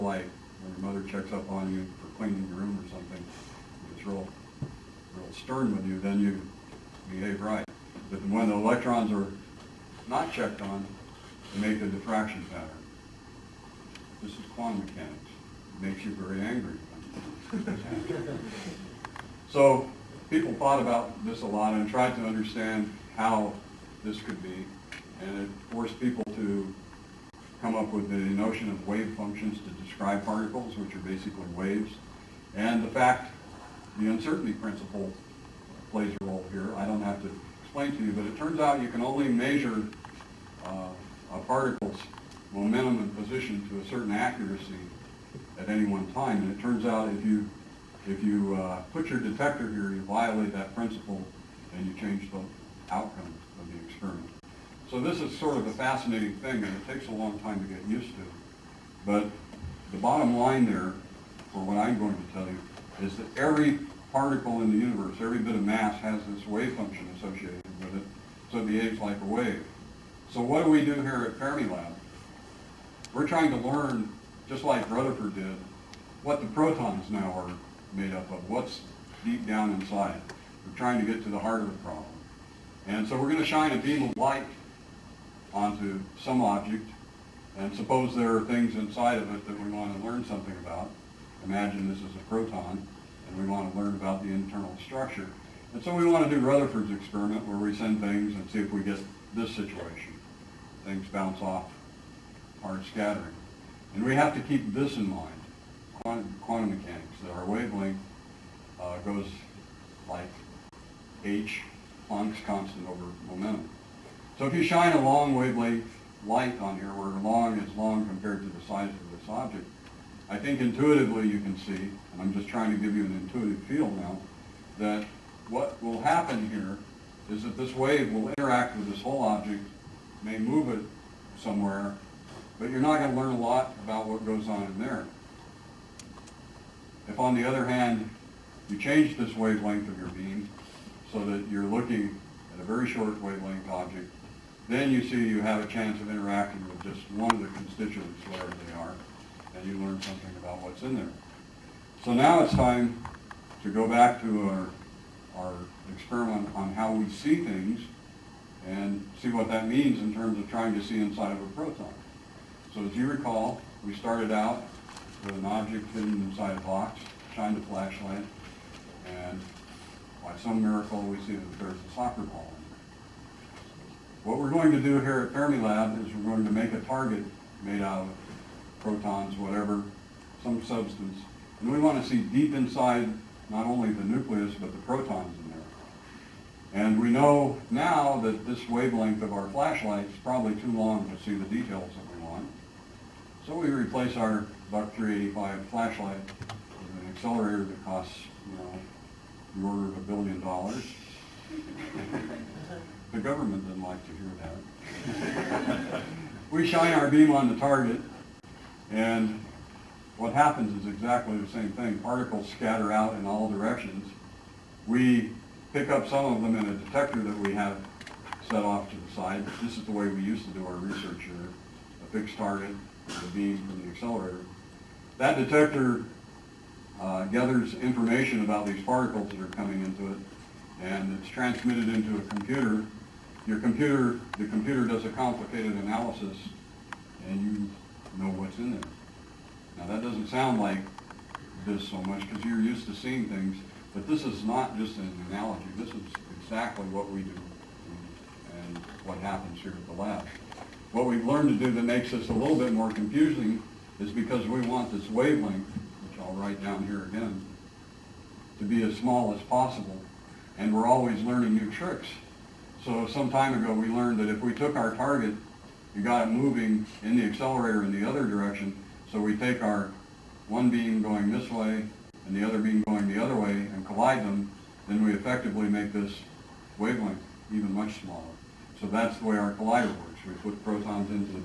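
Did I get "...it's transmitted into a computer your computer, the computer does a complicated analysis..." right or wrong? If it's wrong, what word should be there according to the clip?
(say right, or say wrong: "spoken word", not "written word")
right.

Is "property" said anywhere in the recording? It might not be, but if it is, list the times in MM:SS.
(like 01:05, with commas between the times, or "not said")
not said.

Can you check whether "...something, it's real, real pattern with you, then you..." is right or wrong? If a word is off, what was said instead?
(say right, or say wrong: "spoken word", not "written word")
wrong: "stern", not "pattern".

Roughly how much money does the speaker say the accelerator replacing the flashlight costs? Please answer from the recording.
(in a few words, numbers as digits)
about $1 billion.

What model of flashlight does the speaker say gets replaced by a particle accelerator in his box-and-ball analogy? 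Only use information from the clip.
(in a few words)
Buck 385.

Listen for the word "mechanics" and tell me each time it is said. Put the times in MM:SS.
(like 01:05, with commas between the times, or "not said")
00:14, 01:46.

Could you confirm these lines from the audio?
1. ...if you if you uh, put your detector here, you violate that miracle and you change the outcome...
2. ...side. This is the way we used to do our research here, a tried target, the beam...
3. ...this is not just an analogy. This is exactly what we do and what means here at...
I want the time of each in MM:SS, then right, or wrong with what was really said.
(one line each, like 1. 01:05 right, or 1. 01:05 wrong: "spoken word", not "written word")
1. 00:47 wrong: "principle", not "miracle"
2. 03:39 wrong: "fixed", not "tried"
3. 04:04 wrong: "happens", not "means".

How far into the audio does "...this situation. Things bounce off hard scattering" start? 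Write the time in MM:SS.
01:39.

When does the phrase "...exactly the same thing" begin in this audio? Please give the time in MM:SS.
03:30.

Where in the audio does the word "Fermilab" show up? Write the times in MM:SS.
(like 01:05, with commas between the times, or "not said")
01:11, 02:55.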